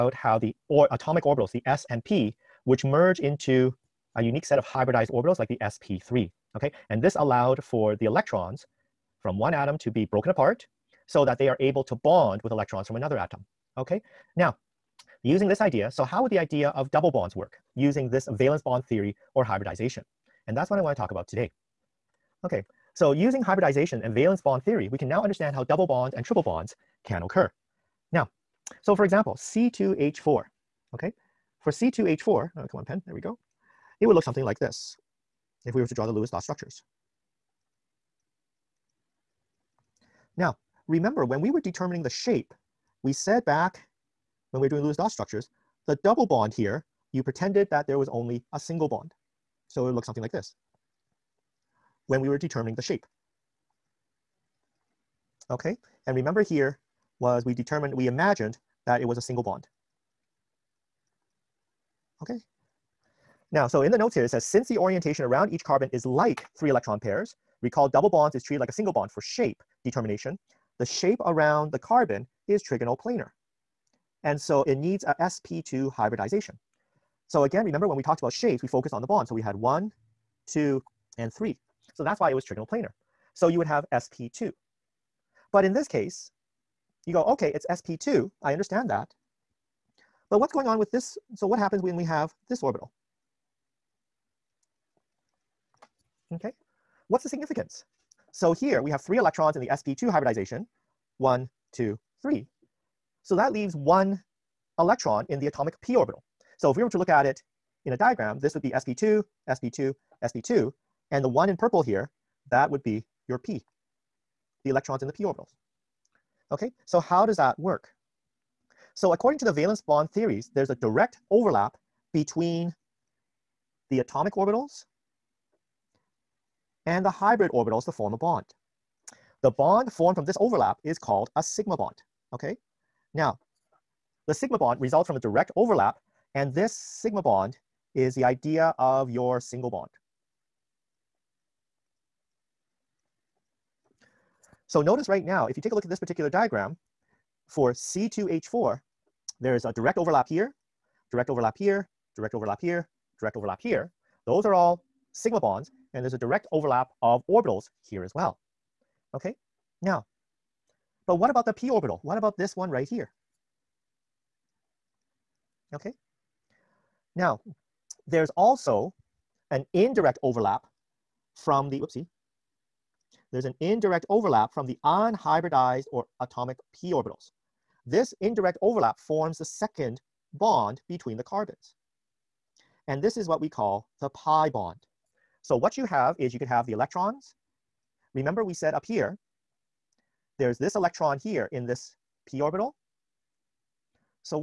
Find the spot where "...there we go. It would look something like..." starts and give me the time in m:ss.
0:33.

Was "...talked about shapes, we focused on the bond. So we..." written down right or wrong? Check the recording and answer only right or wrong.
right.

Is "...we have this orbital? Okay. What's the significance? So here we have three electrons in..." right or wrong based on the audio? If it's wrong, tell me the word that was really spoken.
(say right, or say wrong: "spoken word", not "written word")
right.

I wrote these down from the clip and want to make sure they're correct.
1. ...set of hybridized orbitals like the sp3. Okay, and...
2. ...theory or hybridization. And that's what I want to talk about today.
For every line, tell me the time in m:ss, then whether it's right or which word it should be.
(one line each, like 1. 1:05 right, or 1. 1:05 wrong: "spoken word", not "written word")
1. 0:04 right
2. 0:18 right.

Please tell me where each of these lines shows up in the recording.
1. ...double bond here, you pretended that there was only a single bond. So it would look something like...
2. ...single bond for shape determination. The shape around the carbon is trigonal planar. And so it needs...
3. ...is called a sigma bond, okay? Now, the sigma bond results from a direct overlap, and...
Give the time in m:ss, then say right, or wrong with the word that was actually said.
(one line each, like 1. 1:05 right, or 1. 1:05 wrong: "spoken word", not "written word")
1. 0:46 right
2. 1:08 right
3. 2:10 right.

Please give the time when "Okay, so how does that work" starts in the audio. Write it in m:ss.
1:56.